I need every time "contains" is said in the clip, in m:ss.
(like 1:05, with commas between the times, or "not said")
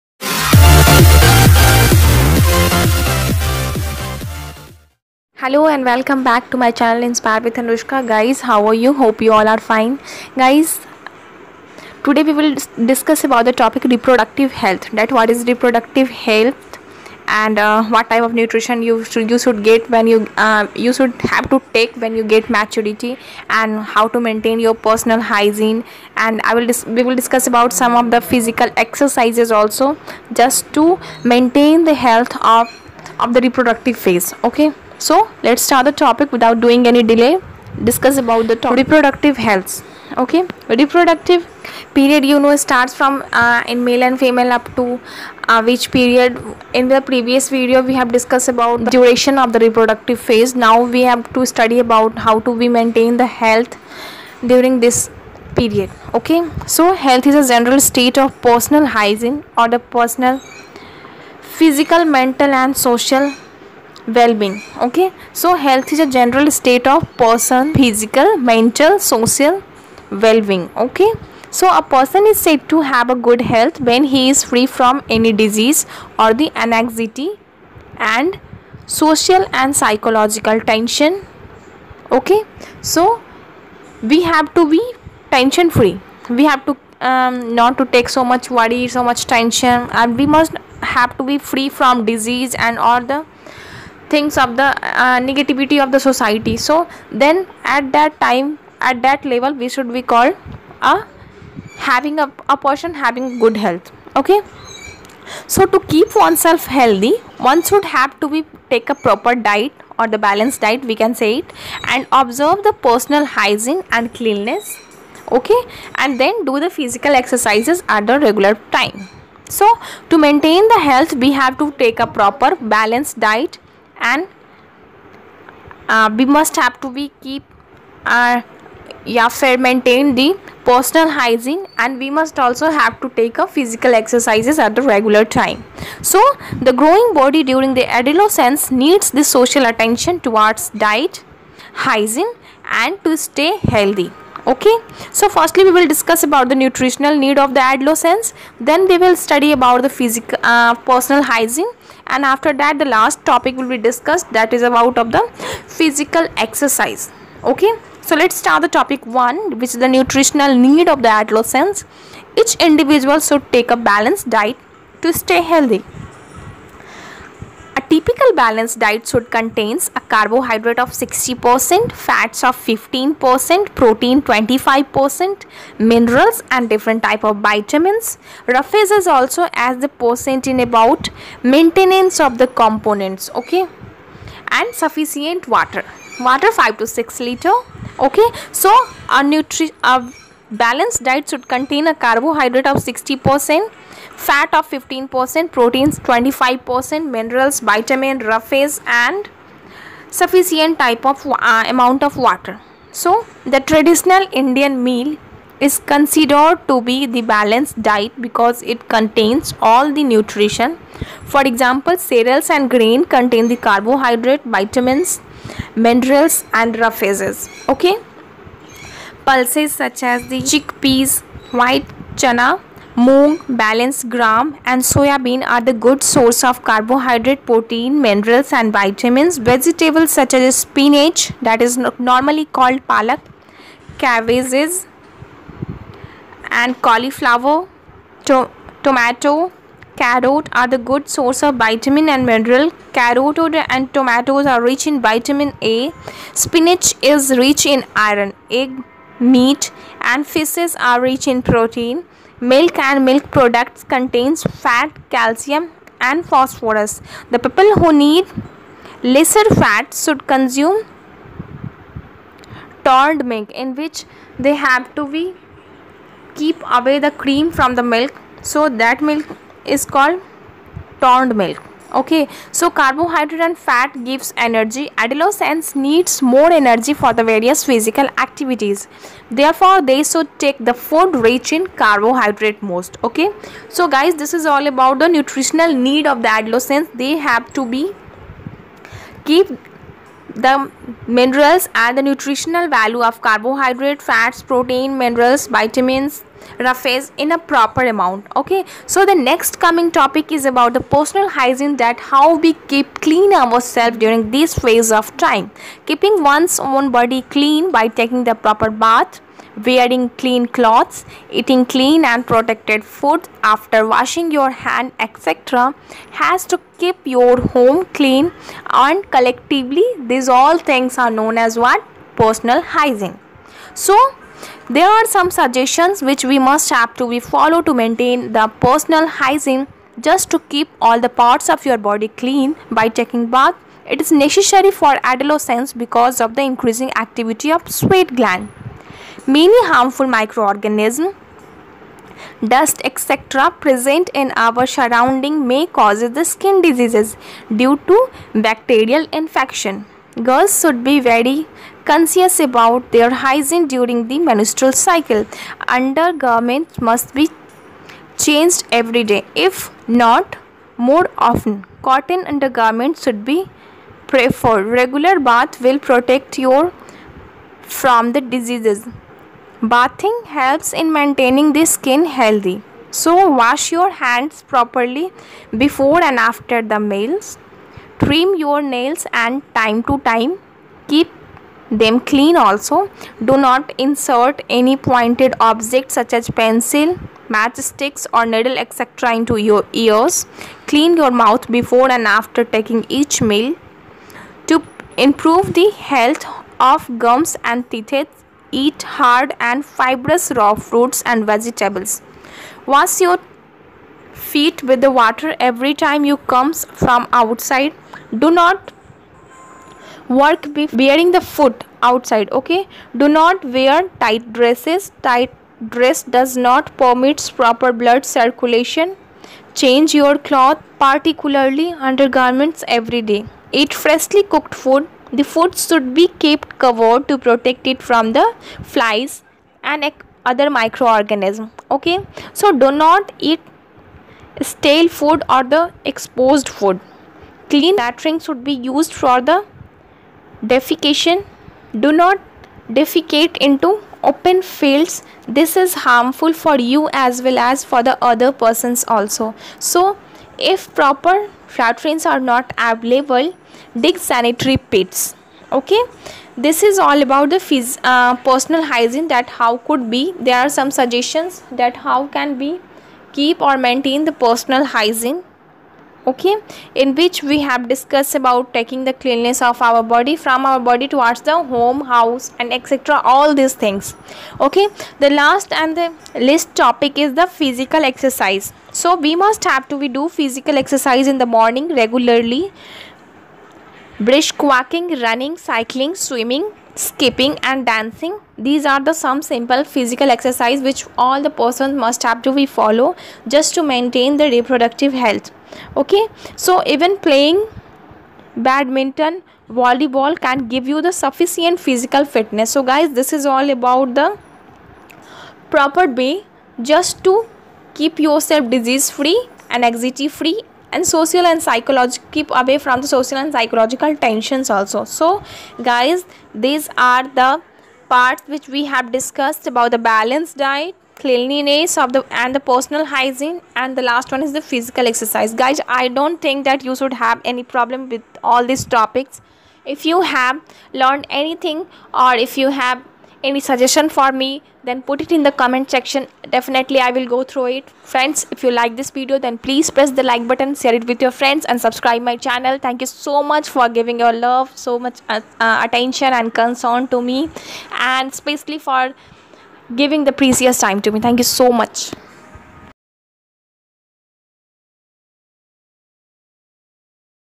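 2:49, 3:11, 3:28, 3:33, 4:13.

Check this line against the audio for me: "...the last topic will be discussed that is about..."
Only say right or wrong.
right.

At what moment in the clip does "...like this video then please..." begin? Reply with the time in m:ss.
8:58.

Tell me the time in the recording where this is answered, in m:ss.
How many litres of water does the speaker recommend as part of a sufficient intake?
3:06.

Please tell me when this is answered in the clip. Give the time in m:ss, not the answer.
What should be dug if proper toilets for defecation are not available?
7:33.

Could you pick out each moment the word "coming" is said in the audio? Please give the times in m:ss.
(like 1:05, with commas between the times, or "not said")
4:59.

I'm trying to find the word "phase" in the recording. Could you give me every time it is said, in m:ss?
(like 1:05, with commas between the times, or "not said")
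0:34, 0:50, 5:04.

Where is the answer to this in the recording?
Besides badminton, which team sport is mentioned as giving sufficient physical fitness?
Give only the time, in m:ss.
8:19.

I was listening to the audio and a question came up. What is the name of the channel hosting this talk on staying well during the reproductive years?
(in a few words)
Inspired with Anushka.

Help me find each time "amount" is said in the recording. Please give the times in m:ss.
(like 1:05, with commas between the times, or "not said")
3:21, 4:57.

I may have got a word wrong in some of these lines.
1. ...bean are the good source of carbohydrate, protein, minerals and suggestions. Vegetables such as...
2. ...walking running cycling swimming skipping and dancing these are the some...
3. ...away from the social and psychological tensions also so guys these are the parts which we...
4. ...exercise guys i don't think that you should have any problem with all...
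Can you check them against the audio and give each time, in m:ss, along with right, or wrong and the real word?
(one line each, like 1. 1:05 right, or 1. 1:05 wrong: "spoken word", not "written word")
1. 3:45 wrong: "vitamins", not "suggestions"
2. 8:04 right
3. 8:32 right
4. 8:44 right.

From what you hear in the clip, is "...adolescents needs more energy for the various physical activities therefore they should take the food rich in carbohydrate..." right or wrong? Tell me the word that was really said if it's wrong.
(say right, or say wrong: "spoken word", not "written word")
right.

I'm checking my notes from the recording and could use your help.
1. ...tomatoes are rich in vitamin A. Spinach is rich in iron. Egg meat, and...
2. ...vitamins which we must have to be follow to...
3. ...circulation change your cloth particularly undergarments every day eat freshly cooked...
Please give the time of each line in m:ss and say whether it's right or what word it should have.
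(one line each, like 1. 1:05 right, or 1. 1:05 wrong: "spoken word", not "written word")
1. 4:03 right
2. 5:25 wrong: "suggestions", not "vitamins"
3. 6:58 right.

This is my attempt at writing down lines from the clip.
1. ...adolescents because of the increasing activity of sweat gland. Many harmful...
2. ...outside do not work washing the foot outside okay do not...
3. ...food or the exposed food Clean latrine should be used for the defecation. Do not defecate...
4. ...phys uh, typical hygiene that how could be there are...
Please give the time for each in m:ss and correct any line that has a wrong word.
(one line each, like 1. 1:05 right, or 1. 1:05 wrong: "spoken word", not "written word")
1. 5:35 right
2. 6:47 wrong: "wearing", not "washing"
3. 7:14 right
4. 7:37 wrong: "personal", not "typical".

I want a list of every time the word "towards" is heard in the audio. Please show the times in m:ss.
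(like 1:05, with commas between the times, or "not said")
2:20, 7:50.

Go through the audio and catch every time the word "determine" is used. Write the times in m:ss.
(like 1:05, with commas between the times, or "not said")
not said.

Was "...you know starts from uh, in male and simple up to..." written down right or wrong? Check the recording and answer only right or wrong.
wrong.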